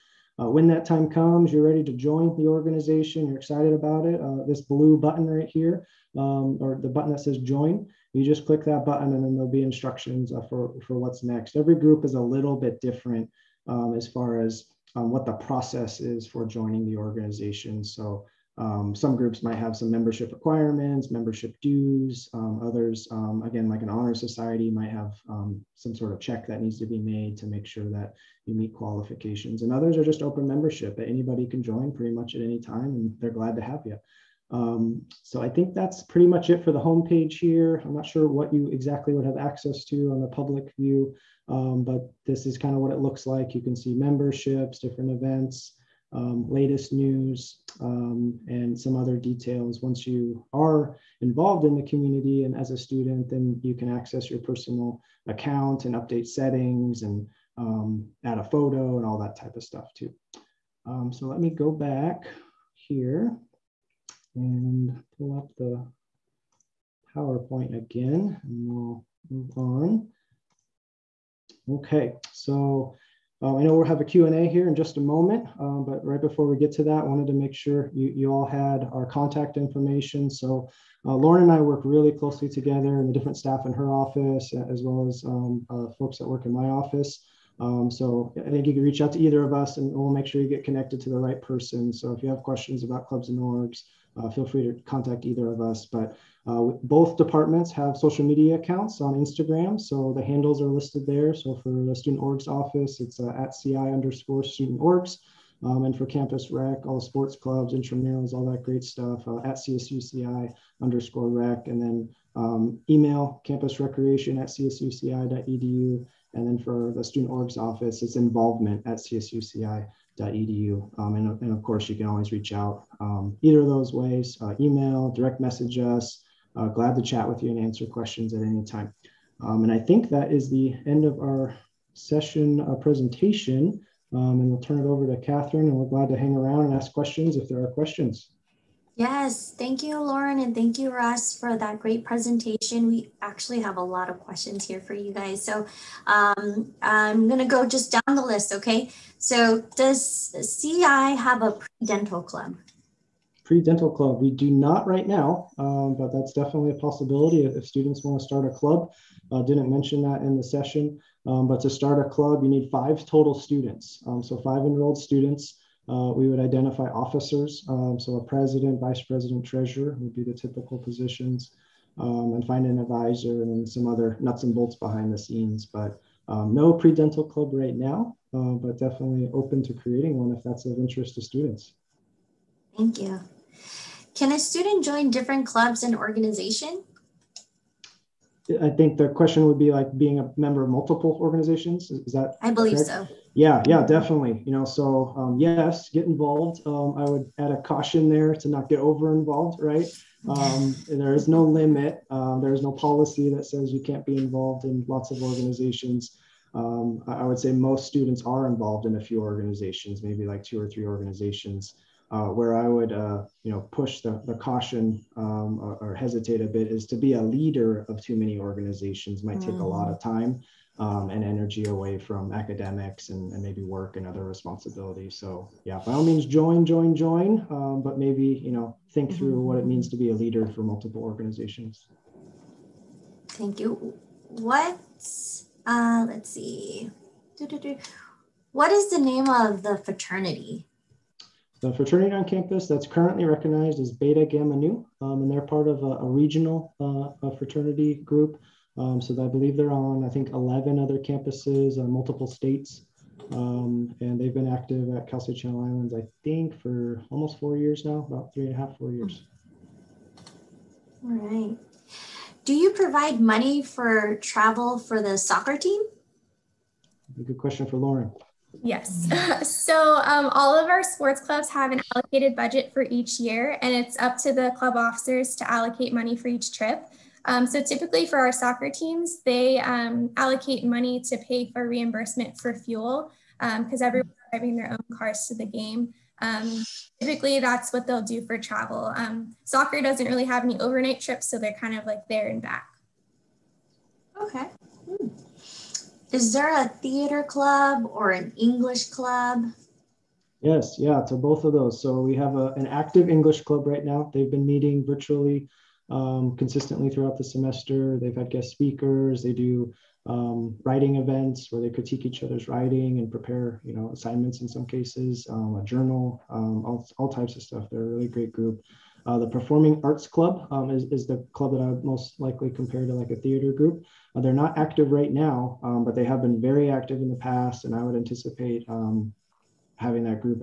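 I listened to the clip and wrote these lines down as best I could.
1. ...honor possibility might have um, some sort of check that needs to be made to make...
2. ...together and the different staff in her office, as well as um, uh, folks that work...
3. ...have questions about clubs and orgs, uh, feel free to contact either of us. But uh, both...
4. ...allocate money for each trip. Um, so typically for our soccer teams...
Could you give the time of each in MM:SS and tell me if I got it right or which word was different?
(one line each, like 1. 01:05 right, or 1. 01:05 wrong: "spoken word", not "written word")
1. 00:23 wrong: "society", not "possibility"
2. 01:22 right
3. 01:32 right
4. 04:35 right.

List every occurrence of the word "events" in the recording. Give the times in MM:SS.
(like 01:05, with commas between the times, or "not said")
00:45, 05:10.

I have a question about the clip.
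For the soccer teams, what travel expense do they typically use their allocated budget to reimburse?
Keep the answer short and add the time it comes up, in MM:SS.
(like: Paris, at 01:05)
fuel, at 04:42.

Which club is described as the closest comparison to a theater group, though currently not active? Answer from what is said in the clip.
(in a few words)
Performing Arts Club.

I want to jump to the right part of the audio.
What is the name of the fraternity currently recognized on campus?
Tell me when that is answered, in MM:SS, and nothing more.
04:03.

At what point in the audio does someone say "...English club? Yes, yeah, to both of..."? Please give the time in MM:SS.
04:58.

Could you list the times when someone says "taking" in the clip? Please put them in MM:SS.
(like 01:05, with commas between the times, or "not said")
not said.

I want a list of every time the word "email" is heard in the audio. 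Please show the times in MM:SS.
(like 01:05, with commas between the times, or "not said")
01:52, 02:04.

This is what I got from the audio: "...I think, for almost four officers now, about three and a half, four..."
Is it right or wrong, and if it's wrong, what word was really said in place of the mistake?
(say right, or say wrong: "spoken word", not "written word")
wrong: "years", not "officers".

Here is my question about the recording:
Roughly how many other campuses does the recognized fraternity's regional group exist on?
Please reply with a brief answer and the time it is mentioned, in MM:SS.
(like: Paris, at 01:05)
11, at 04:10.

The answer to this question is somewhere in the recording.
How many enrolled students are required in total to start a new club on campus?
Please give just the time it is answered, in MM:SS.
02:42.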